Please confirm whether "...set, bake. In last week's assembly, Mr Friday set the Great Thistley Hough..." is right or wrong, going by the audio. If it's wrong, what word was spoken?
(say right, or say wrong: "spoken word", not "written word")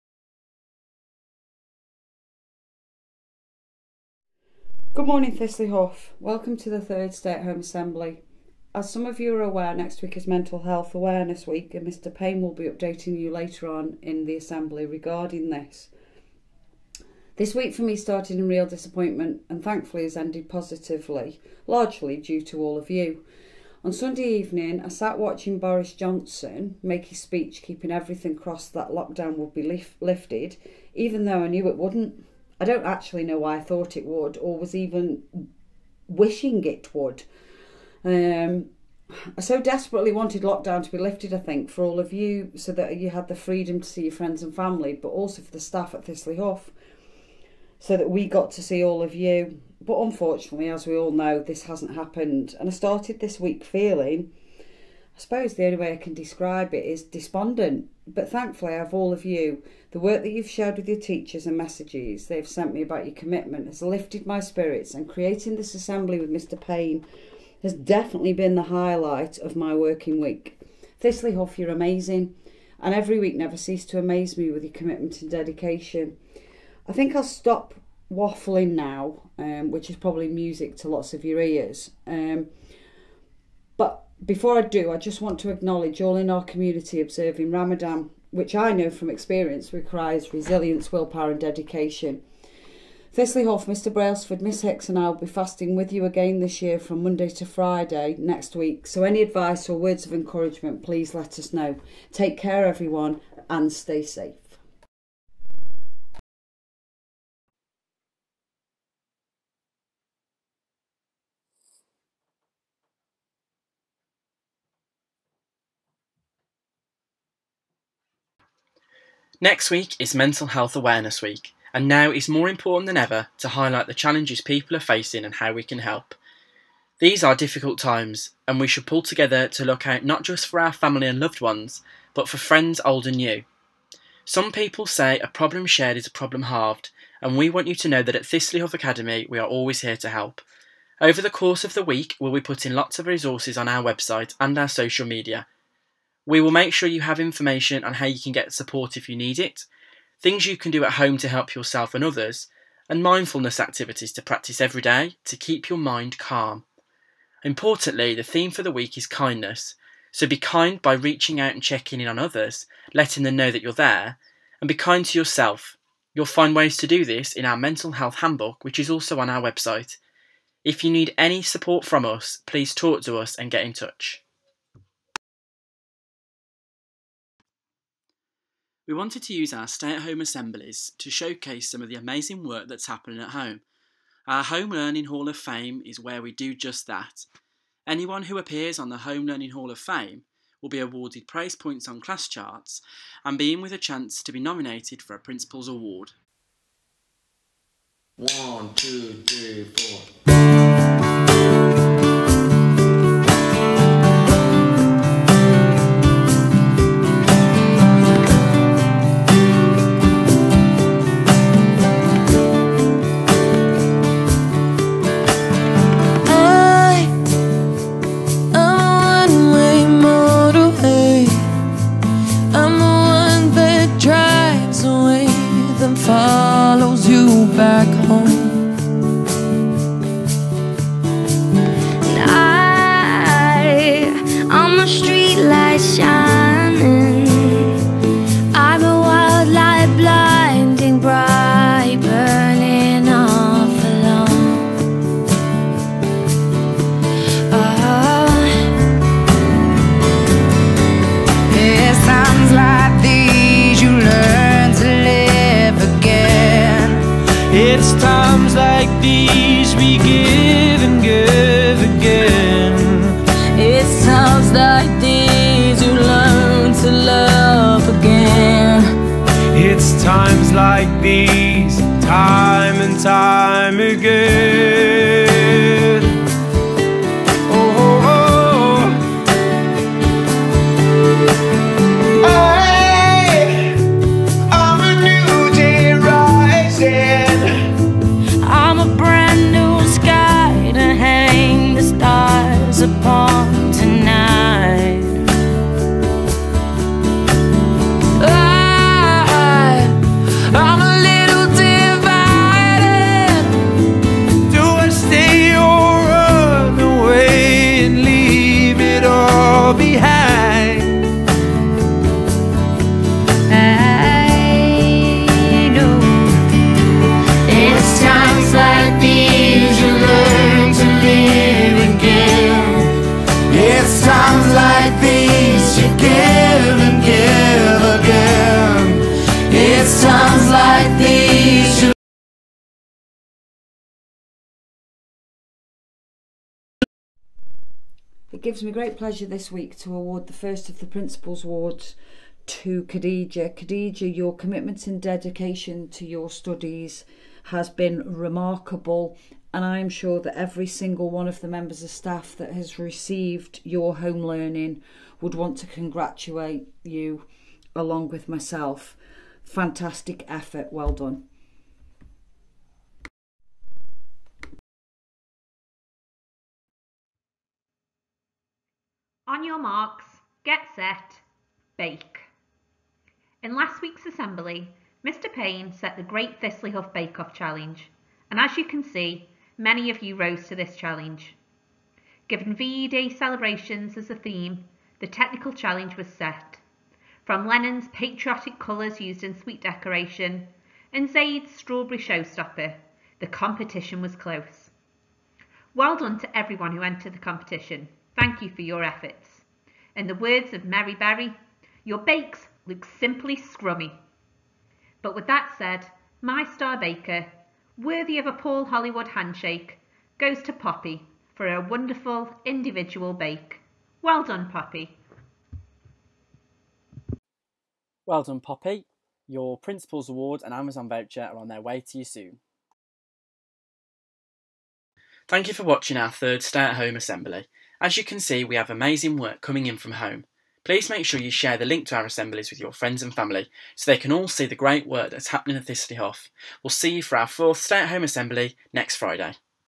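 wrong: "Payne", not "Friday".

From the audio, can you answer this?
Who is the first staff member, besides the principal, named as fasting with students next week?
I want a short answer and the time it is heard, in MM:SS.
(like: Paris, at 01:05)
Mr. Brailsford, at 01:33.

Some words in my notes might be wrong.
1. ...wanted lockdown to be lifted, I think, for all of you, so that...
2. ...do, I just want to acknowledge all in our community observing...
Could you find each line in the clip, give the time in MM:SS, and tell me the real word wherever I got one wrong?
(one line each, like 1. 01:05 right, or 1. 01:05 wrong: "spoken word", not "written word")
1. 00:40 right
2. 01:24 right.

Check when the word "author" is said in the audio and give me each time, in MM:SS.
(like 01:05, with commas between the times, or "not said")
not said.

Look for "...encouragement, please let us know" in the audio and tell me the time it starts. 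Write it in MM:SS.
01:40.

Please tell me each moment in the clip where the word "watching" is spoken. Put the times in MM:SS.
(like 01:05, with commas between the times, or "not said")
00:25, 07:05.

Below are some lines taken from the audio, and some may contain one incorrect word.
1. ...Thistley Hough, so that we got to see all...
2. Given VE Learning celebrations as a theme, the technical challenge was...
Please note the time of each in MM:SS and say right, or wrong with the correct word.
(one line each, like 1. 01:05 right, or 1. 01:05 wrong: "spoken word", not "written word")
1. 00:46 right
2. 06:22 wrong: "Day", not "Learning".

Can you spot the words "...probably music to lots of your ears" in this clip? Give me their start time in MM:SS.
01:19.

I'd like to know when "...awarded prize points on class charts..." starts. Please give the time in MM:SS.
03:10.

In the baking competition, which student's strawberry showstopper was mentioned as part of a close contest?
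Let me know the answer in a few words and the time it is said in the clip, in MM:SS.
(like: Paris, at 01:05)
Zaid, at 06:31.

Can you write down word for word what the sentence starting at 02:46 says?
You'll find ways to do this in our mental health handbook, which is also on our website.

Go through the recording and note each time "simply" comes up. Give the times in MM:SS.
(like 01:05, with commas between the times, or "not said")
06:42.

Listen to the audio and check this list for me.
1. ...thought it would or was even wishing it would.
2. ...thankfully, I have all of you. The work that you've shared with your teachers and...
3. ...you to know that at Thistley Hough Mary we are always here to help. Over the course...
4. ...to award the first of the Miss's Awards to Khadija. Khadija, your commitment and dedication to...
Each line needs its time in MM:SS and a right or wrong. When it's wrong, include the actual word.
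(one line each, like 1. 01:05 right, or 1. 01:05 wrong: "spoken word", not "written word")
1. 00:33 right
2. 00:58 right
3. 02:17 wrong: "Academy", not "Mary"
4. 05:39 wrong: "Principal", not "Miss".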